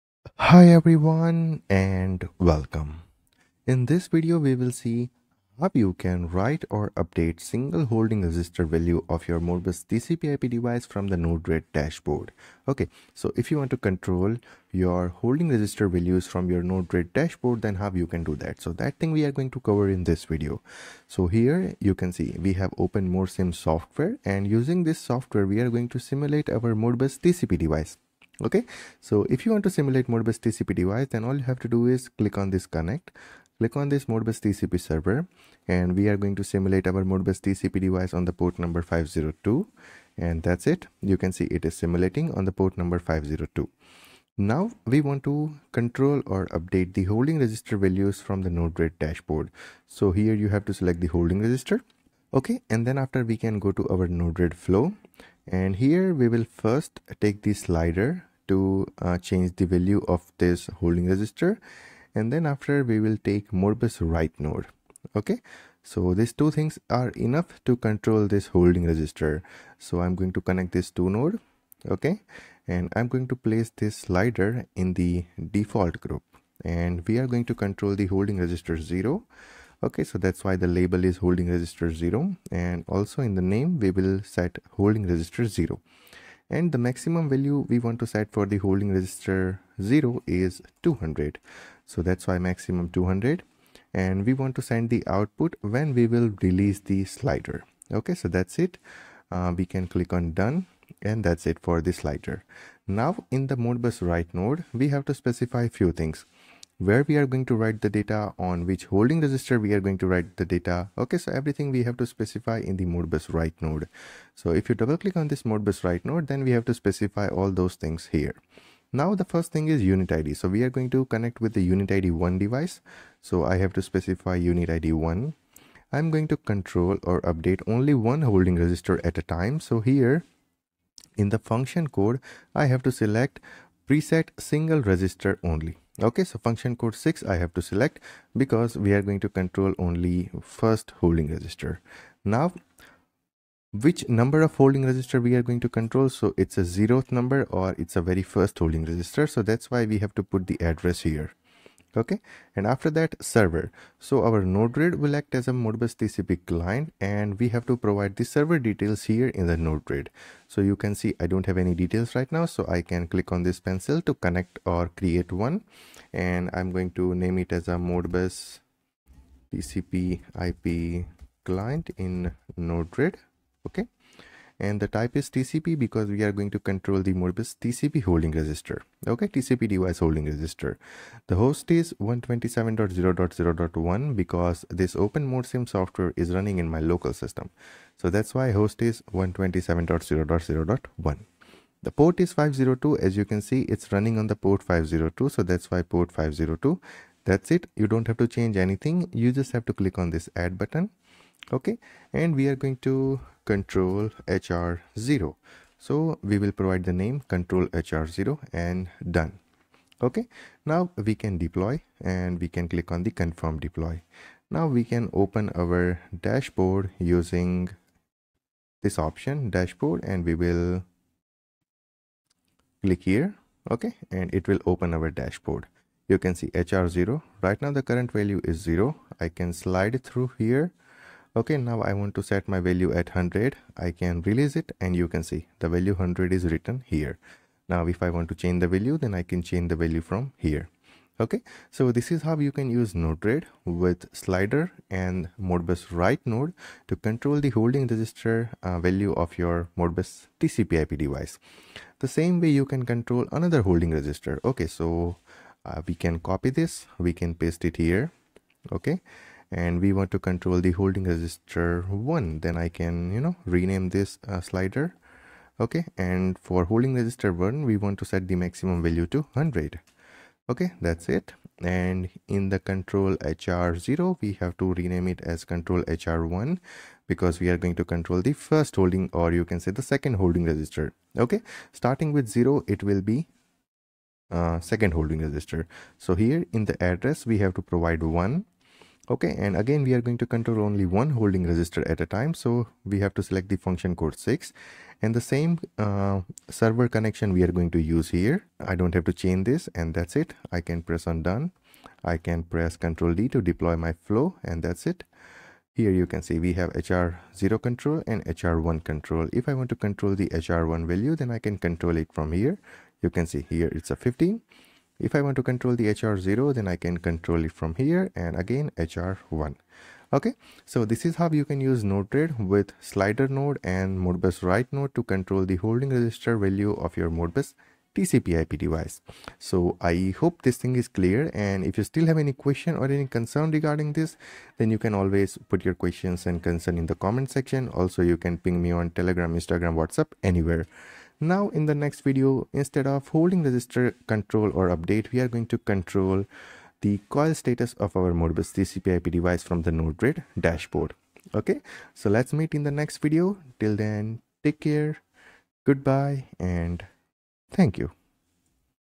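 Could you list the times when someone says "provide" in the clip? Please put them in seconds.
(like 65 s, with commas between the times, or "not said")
157 s, 206 s, 287 s.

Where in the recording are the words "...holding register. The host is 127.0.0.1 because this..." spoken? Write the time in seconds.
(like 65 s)
179 s.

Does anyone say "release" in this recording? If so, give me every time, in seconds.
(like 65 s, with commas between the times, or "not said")
96 s, 234 s.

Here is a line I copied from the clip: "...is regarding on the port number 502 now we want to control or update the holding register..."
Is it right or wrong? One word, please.
wrong.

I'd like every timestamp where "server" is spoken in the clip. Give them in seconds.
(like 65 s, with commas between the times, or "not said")
34 s, 153 s, 158 s, 296 s.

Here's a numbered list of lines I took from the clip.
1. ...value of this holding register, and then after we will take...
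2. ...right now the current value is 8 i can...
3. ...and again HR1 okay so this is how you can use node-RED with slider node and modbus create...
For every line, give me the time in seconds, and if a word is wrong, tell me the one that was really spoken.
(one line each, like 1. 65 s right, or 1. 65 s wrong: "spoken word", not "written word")
1. 59 s right
2. 227 s wrong: "0", not "8"
3. 318 s wrong: "write", not "create".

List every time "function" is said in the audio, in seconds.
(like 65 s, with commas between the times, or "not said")
131 s, 136 s, 293 s.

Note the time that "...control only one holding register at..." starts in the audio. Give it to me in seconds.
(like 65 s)
290 s.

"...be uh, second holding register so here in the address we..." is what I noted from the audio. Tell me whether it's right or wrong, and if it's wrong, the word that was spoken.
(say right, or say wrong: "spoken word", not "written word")
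right.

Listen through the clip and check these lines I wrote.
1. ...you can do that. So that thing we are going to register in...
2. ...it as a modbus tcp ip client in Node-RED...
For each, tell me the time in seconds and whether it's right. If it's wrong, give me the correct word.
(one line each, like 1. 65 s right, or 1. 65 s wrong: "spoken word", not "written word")
1. 17 s wrong: "cover", not "register"
2. 167 s right.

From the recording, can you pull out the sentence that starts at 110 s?
Okay, so everything we have to specify in the Modbus write node.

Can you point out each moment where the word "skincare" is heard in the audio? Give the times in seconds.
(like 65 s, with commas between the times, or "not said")
not said.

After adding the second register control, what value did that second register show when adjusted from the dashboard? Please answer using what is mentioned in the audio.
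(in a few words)
15.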